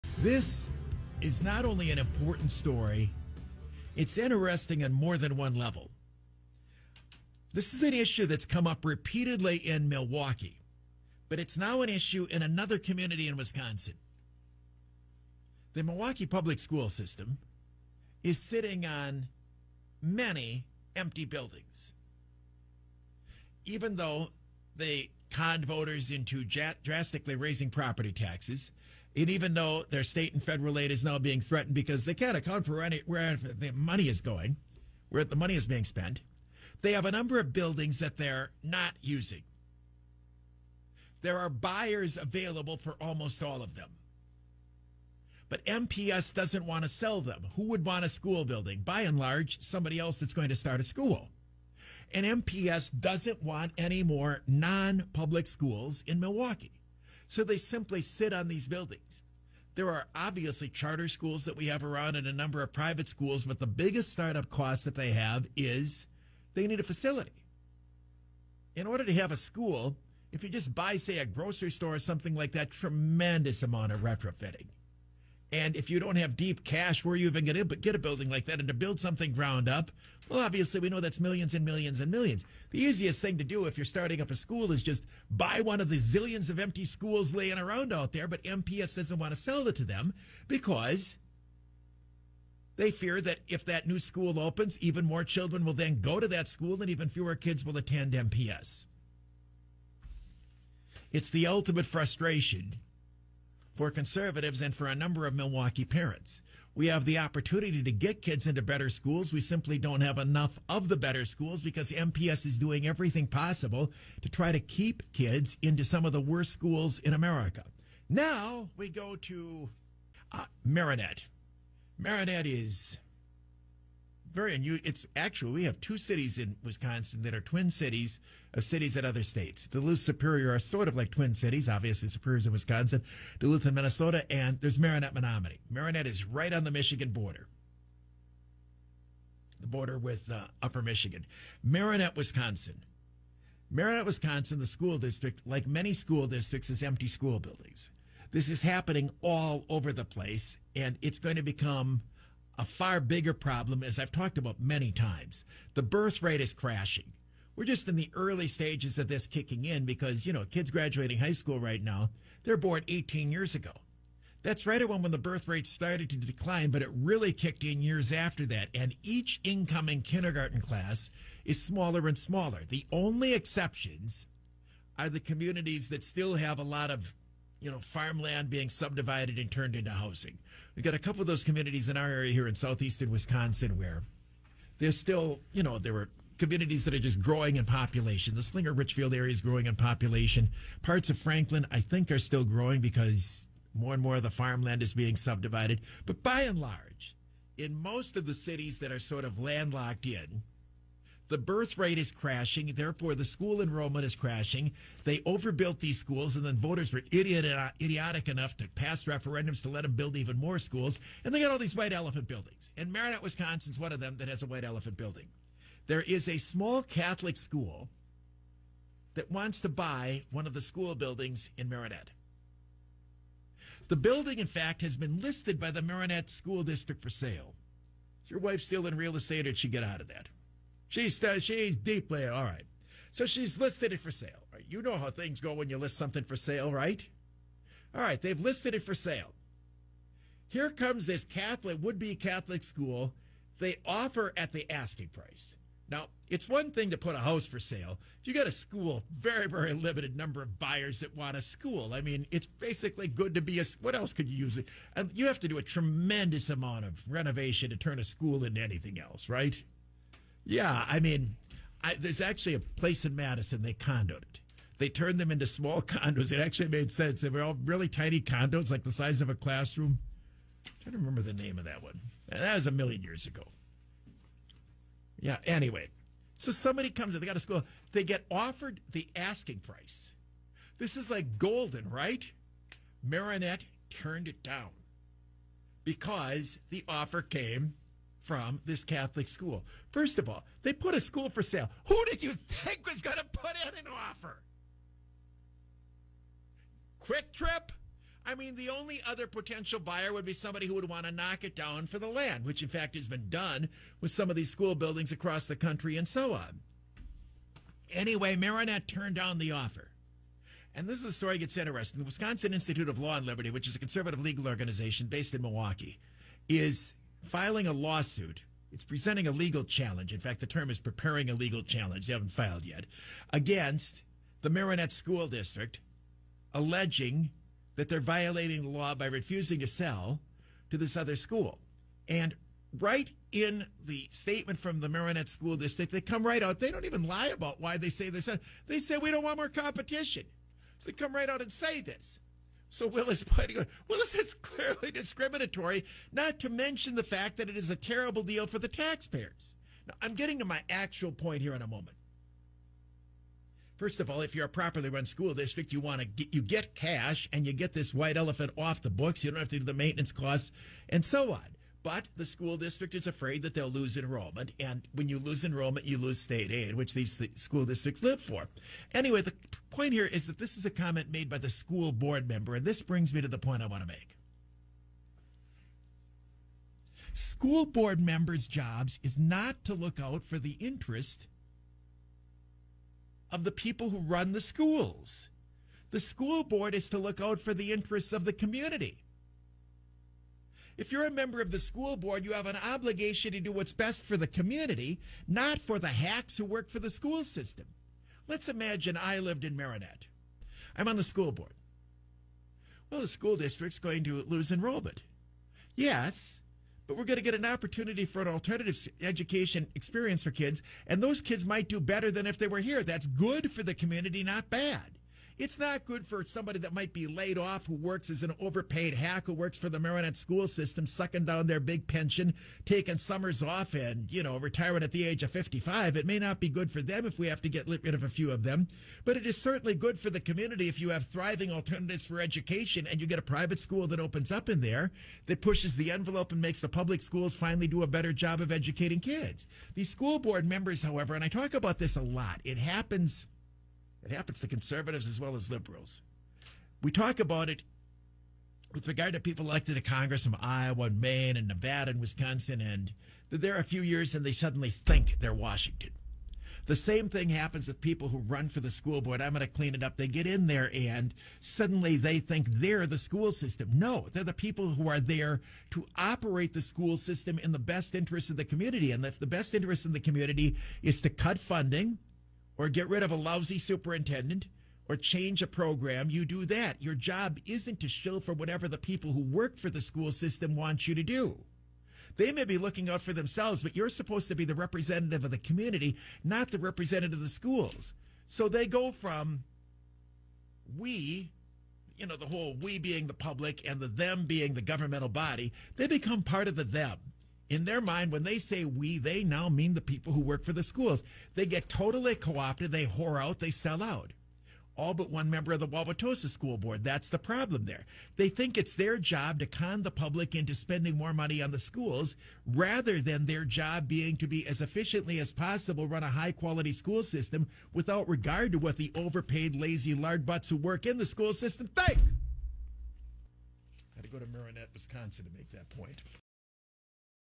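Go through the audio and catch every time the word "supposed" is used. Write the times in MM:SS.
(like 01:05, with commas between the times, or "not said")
08:03.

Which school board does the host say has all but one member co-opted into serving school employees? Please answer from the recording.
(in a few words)
Wauwatosa School Board.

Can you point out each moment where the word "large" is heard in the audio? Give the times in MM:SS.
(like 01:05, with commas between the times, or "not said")
00:49, 03:16.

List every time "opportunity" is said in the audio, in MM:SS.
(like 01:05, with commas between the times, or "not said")
01:47, 06:47.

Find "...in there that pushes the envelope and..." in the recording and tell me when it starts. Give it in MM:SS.
07:14.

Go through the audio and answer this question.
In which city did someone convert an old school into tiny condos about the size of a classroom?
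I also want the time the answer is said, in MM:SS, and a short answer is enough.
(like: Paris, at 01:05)
Madison, at 04:23.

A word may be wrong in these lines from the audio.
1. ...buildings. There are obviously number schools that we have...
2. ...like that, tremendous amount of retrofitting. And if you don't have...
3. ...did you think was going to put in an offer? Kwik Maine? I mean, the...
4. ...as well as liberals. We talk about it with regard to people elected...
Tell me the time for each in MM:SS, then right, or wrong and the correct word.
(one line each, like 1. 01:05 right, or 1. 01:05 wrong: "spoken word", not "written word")
1. 00:58 wrong: "charter", not "number"
2. 01:12 right
3. 04:52 wrong: "Trip", not "Maine"
4. 07:25 right.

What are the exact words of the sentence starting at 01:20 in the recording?
Well, obviously, we know that's millions and millions and millions.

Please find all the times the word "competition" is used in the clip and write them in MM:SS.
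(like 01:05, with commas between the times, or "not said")
05:39.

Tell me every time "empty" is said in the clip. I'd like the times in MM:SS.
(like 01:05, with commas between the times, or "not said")
00:20, 01:26, 02:26.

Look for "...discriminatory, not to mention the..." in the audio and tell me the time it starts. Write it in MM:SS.
05:44.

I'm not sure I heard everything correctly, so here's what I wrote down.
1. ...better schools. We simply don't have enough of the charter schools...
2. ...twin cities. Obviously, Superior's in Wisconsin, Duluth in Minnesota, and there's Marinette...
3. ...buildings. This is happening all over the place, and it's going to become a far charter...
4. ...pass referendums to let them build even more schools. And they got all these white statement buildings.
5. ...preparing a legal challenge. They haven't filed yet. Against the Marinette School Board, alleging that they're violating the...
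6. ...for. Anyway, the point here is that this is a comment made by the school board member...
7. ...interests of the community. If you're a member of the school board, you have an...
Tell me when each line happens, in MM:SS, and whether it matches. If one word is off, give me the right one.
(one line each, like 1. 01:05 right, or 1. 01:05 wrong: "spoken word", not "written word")
1. 01:48 wrong: "better", not "charter"
2. 02:11 right
3. 02:27 wrong: "bigger", not "charter"
4. 03:28 wrong: "elephant", not "statement"
5. 05:20 wrong: "District", not "Board"
6. 06:08 right
7. 06:27 right.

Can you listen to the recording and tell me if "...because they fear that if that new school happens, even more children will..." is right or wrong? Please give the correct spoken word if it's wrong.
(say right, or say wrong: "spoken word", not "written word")
wrong: "opens", not "happens".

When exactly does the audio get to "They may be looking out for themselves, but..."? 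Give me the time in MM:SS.
08:02.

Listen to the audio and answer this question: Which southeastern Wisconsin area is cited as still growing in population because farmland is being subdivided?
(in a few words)
Slinger Richfield.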